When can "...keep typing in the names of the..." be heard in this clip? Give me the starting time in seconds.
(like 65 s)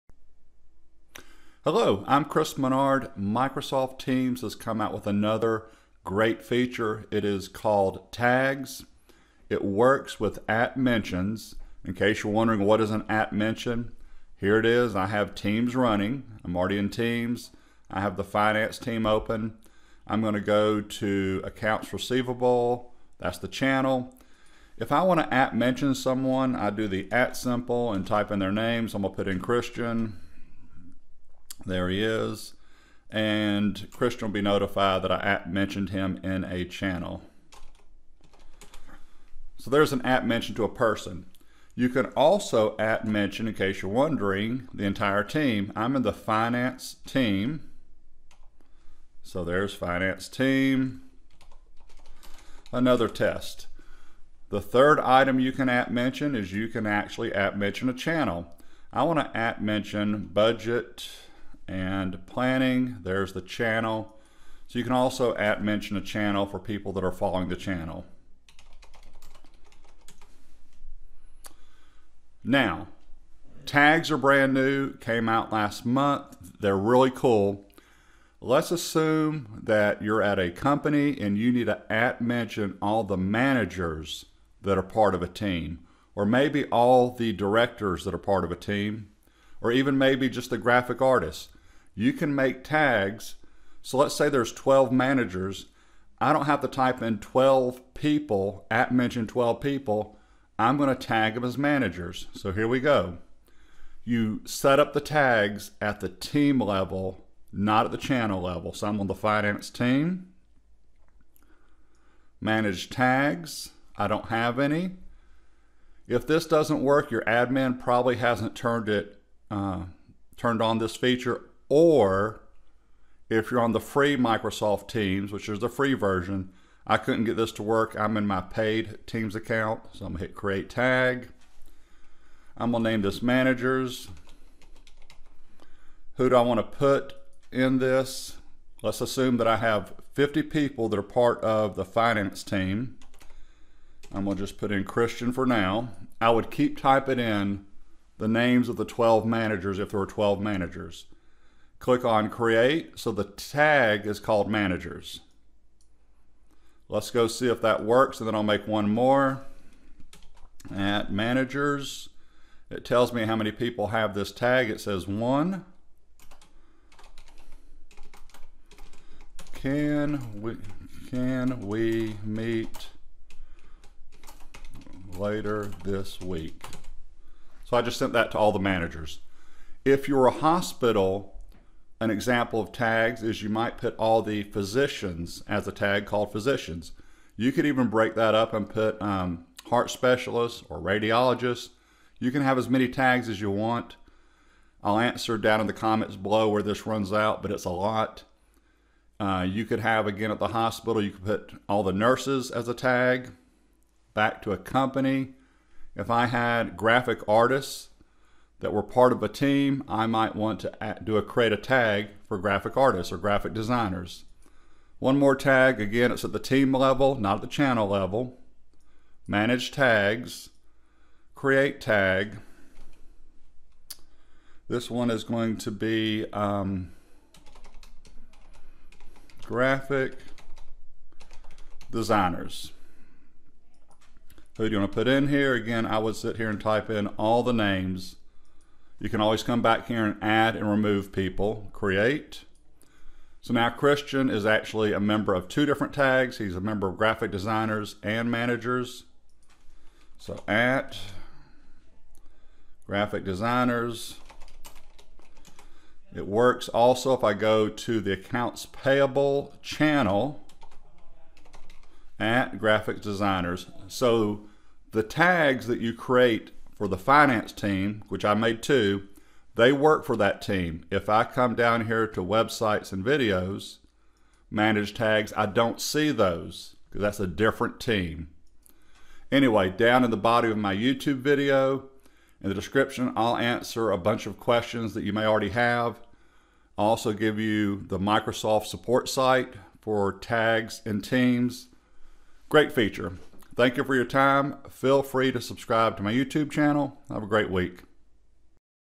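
146 s.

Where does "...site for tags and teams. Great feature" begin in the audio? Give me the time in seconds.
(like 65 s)
289 s.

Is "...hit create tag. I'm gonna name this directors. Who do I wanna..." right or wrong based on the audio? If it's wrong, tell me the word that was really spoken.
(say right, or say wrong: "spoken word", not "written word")
wrong: "managers", not "directors".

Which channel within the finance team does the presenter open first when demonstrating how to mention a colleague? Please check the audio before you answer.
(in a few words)
Accounts receivable.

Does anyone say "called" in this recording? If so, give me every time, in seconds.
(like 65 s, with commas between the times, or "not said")
7 s, 154 s, 186 s.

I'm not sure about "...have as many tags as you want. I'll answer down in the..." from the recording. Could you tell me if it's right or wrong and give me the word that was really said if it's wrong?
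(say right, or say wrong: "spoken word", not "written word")
right.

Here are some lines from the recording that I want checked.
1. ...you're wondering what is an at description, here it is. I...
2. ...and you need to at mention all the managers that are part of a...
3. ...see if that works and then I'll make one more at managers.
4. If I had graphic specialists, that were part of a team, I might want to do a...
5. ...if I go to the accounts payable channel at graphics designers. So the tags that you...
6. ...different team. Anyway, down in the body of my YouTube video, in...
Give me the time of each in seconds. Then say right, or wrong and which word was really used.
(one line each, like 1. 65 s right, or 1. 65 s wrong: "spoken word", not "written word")
1. 12 s wrong: "mention", not "description"
2. 81 s right
3. 157 s right
4. 205 s wrong: "artists", not "specialists"
5. 257 s right
6. 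277 s right.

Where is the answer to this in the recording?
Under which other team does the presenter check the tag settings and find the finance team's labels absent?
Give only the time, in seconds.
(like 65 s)
272 s.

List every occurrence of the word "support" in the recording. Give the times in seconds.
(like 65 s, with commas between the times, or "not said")
288 s.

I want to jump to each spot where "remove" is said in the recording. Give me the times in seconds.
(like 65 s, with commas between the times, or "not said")
240 s.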